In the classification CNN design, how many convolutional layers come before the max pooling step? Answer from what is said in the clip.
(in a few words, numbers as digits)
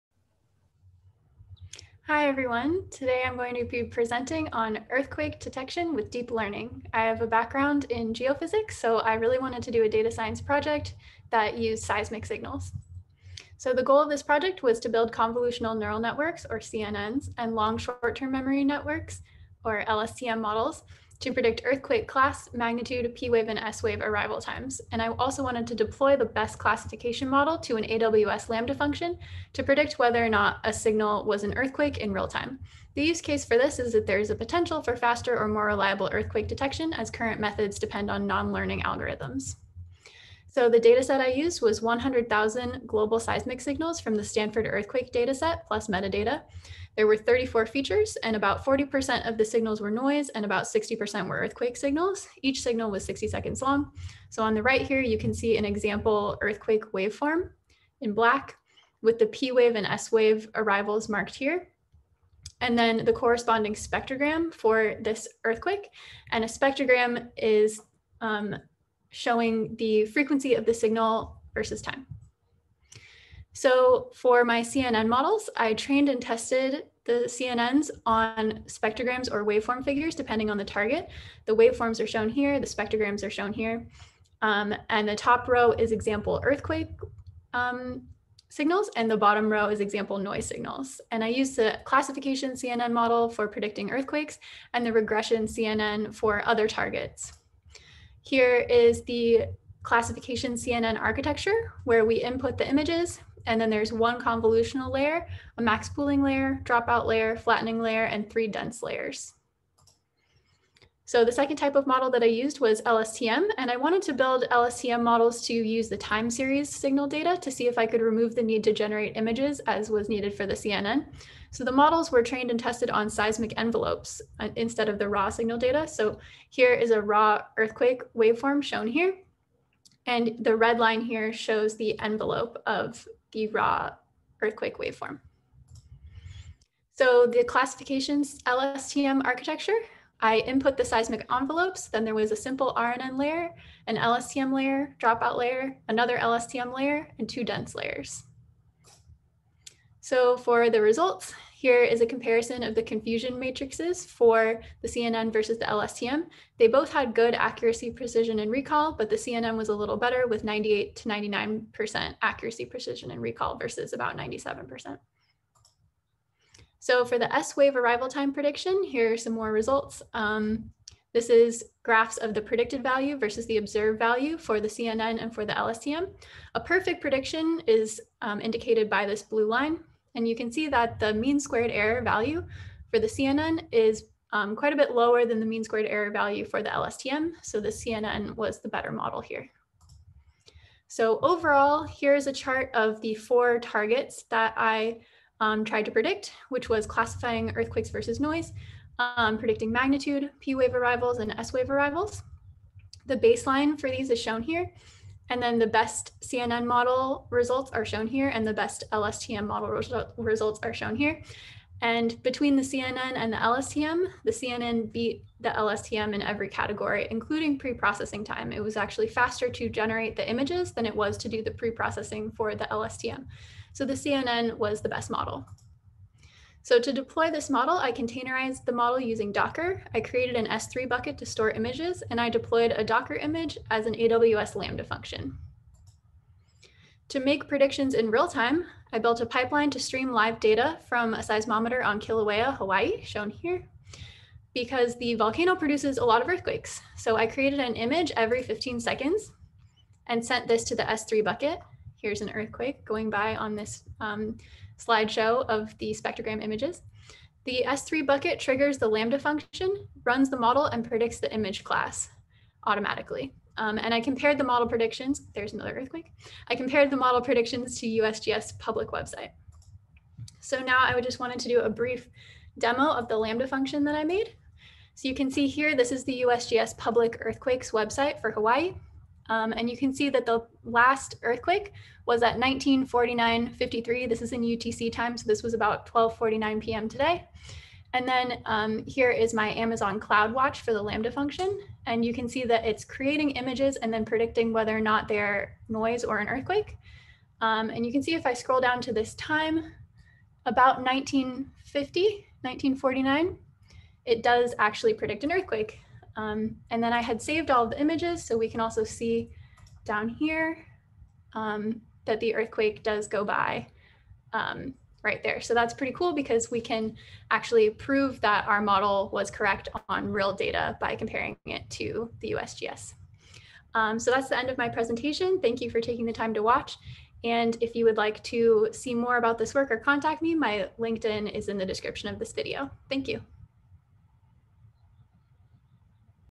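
1.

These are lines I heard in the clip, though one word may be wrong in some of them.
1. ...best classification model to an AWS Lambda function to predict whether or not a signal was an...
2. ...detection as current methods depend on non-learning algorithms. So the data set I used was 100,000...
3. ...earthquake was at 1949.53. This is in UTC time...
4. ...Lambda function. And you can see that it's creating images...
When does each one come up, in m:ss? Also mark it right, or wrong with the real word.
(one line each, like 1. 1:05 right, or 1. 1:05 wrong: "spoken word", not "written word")
1. 0:26 right
2. 0:36 right
3. 4:41 right
4. 4:50 right.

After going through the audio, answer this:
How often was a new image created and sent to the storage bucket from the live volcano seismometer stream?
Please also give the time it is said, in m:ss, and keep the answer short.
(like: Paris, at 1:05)
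Every 15 seconds, at 4:08.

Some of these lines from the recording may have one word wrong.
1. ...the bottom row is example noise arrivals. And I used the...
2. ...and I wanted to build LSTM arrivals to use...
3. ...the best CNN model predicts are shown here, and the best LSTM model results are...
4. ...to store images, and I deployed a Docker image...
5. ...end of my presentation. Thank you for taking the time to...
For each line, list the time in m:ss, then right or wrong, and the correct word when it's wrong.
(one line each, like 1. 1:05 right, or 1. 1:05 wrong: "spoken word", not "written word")
1. 1:29 wrong: "signals", not "arrivals"
2. 1:53 wrong: "models", not "arrivals"
3. 3:25 wrong: "results", not "predicts"
4. 3:51 right
5. 5:24 right.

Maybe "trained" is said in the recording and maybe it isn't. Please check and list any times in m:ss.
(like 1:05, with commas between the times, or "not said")
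1:15, 2:02.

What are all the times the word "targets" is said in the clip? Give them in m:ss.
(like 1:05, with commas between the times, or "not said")
1:20, 1:36, 3:13.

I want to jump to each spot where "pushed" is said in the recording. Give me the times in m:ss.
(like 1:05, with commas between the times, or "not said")
not said.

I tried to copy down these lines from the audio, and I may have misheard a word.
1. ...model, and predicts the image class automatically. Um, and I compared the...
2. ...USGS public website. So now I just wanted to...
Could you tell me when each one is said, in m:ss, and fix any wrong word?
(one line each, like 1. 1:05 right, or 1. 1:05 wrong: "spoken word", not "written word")
1. 4:20 right
2. 4:27 right.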